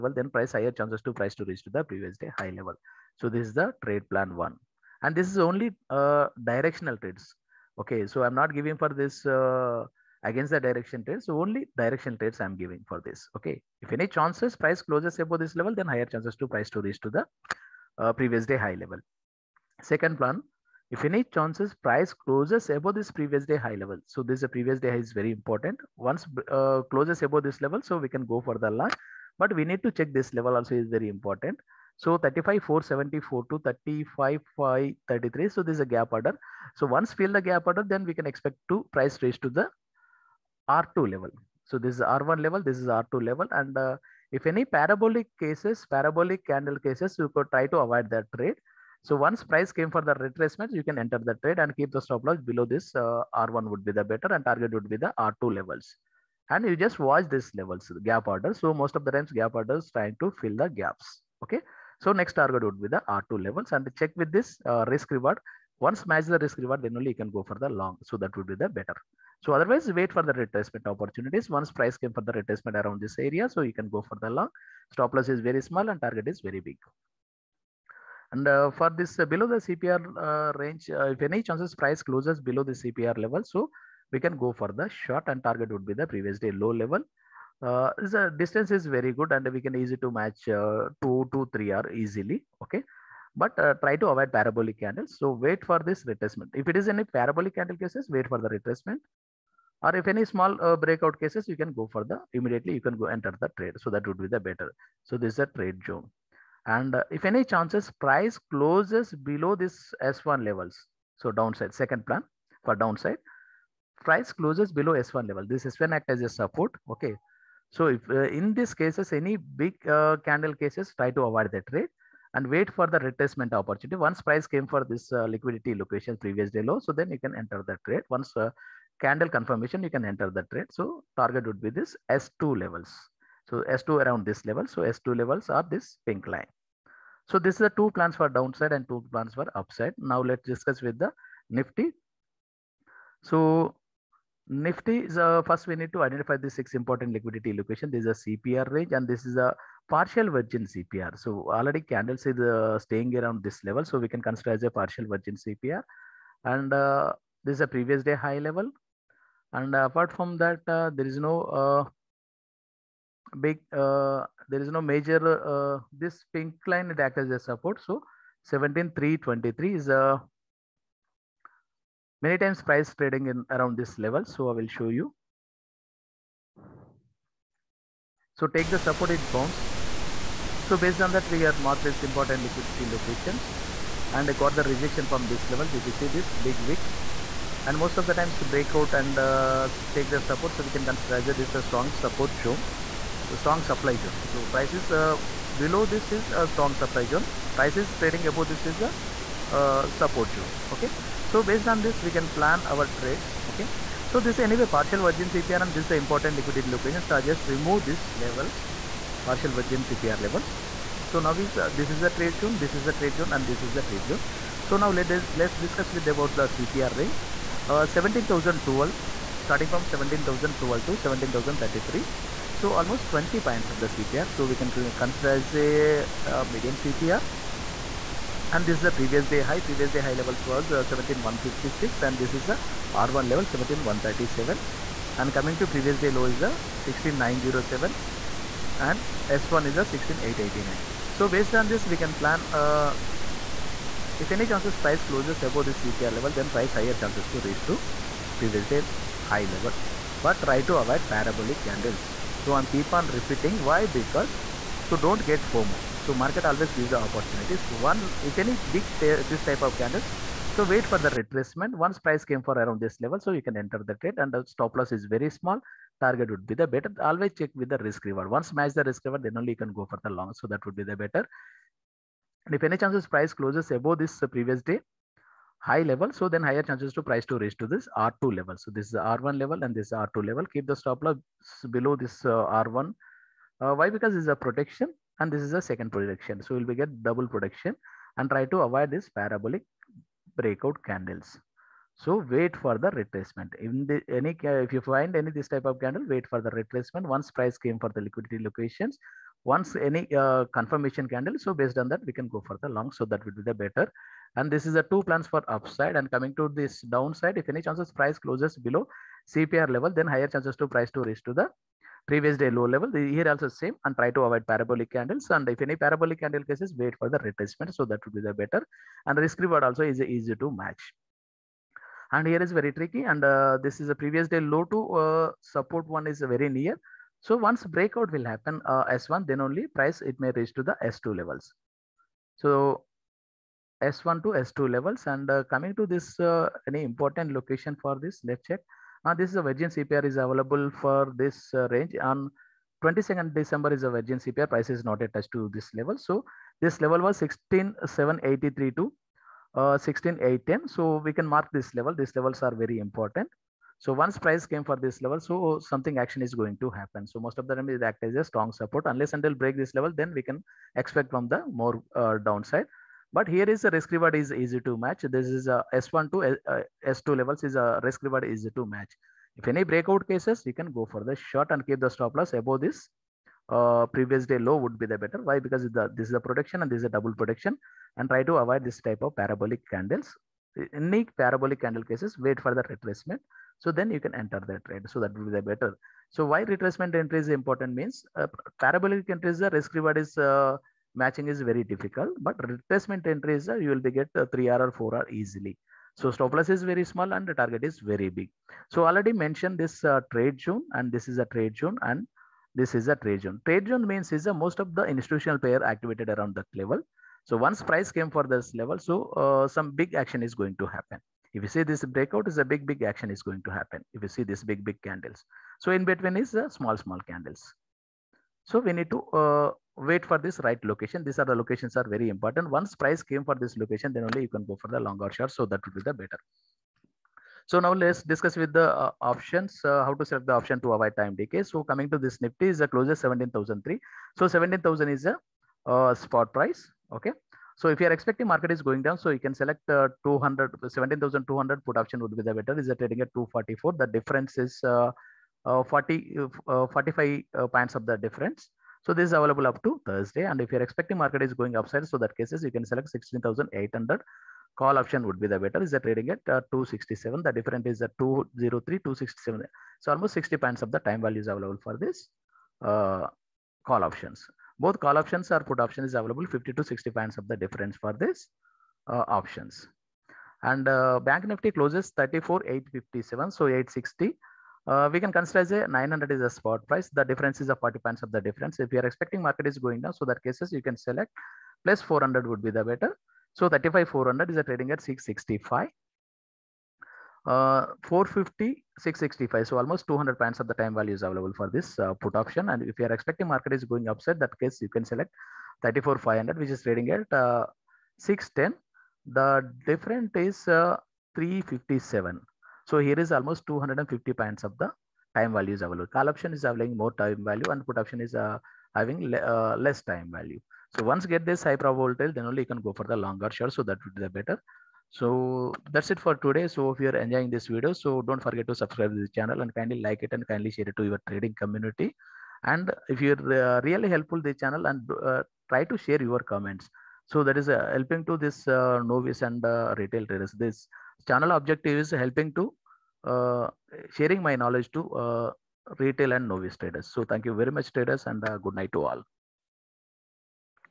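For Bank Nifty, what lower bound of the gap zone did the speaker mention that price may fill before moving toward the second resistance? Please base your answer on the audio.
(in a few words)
35,474.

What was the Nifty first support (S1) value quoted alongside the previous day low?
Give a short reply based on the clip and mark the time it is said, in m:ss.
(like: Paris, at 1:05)
16889, at 3:59.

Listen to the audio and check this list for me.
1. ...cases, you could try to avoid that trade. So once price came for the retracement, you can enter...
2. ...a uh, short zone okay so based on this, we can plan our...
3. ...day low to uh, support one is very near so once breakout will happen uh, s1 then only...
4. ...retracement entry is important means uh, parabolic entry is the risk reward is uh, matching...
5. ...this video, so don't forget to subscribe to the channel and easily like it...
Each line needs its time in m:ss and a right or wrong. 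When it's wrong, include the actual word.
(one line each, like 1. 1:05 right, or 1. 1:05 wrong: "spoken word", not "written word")
1. 0:46 right
2. 3:18 wrong: "support", not "short"
3. 5:24 right
4. 6:26 right
5. 8:37 wrong: "kindly", not "easily".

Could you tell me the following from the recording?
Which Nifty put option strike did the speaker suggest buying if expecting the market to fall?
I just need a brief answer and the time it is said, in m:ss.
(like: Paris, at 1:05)
17,200, at 7:20.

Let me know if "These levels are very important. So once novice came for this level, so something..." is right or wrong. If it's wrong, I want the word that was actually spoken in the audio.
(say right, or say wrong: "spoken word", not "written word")
wrong: "price", not "novice".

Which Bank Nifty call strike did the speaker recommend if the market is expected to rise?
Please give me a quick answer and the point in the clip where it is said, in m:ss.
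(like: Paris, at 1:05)
34,500, at 8:15.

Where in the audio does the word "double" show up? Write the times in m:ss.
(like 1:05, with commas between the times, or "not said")
4:47, 6:16.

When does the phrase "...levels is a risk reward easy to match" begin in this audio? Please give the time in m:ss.
6:07.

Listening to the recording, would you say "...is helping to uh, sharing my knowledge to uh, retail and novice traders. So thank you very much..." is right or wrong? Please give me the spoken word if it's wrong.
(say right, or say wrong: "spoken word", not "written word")
right.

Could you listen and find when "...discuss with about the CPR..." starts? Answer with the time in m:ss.
3:35.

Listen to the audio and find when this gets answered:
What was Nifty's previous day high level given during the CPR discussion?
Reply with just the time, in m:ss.
3:50.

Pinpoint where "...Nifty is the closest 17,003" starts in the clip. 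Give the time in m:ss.
7:12.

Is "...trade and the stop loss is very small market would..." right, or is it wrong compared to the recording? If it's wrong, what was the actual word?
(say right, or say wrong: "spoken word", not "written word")
wrong: "target", not "market".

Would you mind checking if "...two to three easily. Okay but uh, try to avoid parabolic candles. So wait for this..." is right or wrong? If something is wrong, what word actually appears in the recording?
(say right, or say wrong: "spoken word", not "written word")
right.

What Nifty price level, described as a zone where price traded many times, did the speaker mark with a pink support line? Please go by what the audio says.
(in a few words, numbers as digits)
17323.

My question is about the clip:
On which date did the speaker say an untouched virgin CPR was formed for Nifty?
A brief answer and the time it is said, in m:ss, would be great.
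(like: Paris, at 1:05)
22nd December, at 5:42.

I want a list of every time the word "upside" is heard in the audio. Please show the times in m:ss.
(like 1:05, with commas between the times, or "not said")
2:19, 5:05, 7:31, 8:13.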